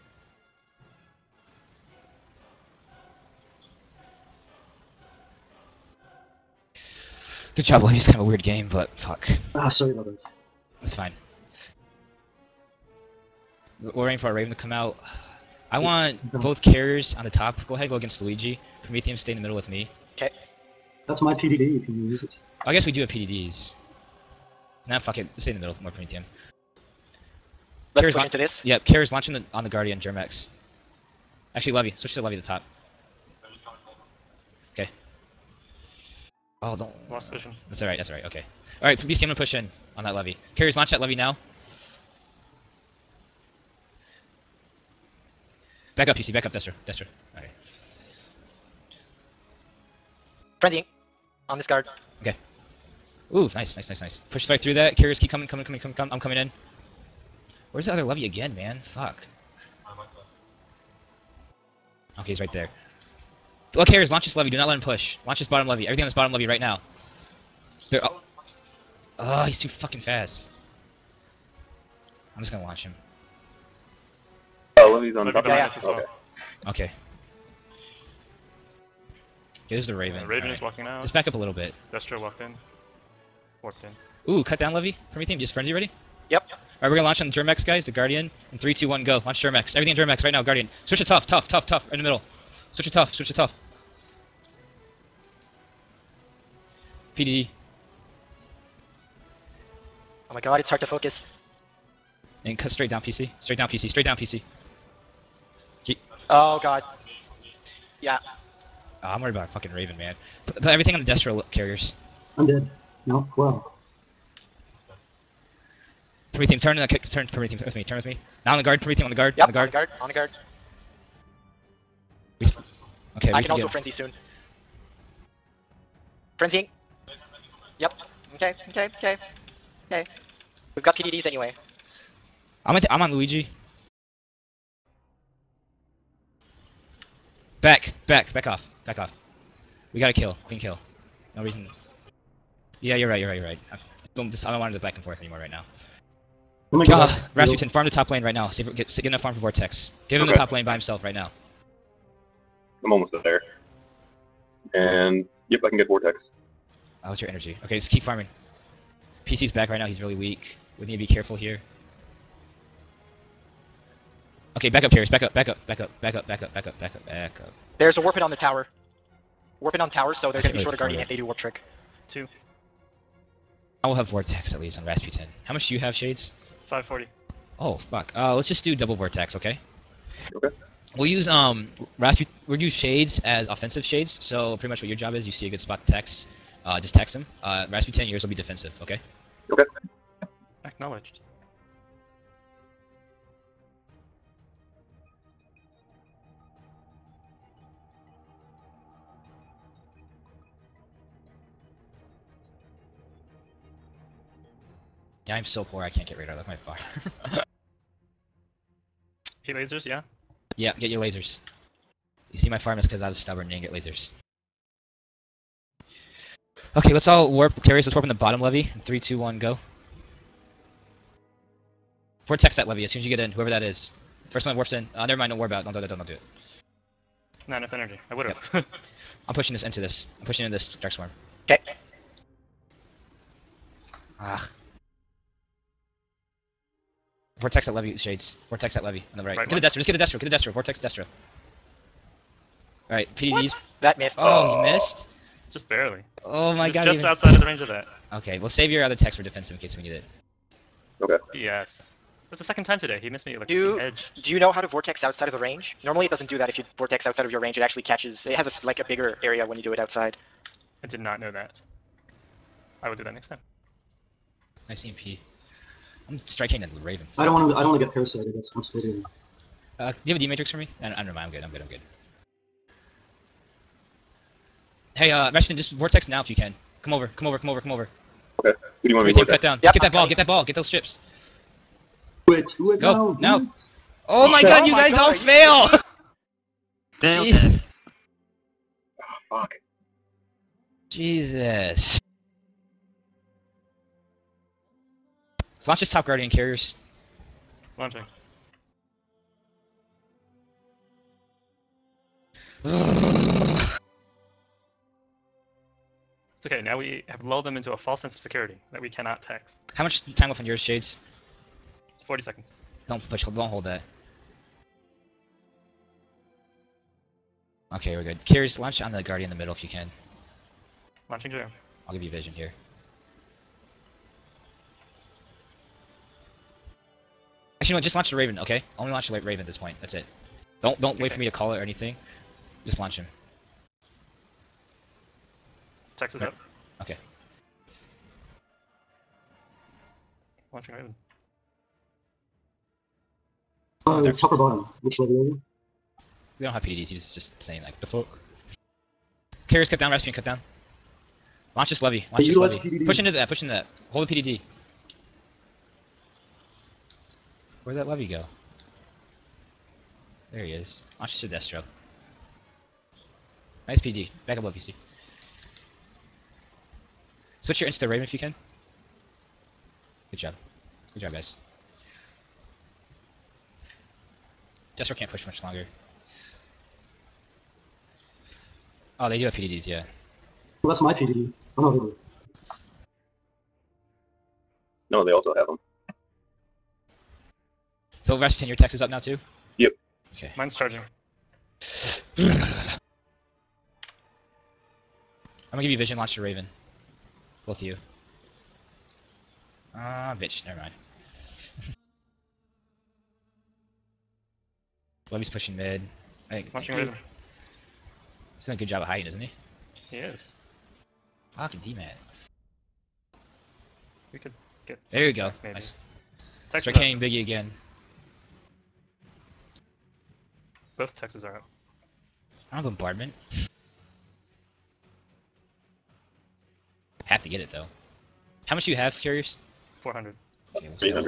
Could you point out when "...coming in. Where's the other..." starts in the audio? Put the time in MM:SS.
00:56.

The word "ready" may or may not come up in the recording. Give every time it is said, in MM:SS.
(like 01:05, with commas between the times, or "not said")
01:25.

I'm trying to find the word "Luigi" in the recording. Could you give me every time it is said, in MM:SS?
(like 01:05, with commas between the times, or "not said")
00:18, 02:13.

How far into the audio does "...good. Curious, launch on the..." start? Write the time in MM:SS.
05:18.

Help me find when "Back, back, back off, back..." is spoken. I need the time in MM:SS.
02:17.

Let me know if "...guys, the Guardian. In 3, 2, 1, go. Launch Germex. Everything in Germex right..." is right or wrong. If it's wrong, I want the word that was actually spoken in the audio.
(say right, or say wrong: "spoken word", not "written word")
right.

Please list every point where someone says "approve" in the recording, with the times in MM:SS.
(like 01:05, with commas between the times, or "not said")
not said.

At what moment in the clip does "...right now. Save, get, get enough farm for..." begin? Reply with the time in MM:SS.
02:28.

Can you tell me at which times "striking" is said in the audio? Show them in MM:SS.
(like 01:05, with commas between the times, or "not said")
04:26.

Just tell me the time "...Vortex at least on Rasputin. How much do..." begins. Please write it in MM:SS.
02:54.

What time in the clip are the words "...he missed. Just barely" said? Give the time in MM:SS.
04:04.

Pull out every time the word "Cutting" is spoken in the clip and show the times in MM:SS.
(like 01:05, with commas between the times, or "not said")
04:40.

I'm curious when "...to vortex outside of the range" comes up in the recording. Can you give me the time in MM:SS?
04:14.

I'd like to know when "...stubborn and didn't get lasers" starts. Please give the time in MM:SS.
03:33.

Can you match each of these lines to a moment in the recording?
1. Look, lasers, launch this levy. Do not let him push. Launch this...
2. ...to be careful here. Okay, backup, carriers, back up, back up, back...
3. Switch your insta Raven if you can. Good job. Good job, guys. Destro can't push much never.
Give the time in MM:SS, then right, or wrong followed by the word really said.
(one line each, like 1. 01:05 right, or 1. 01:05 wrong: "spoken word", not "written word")
1. 01:03 wrong: "carriers", not "lasers"
2. 02:40 right
3. 06:07 wrong: "longer", not "never".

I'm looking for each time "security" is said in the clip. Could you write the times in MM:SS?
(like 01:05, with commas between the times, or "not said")
05:08.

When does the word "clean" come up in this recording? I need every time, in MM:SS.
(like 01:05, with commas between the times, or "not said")
02:20.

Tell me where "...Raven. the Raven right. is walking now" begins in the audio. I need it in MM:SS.
01:19.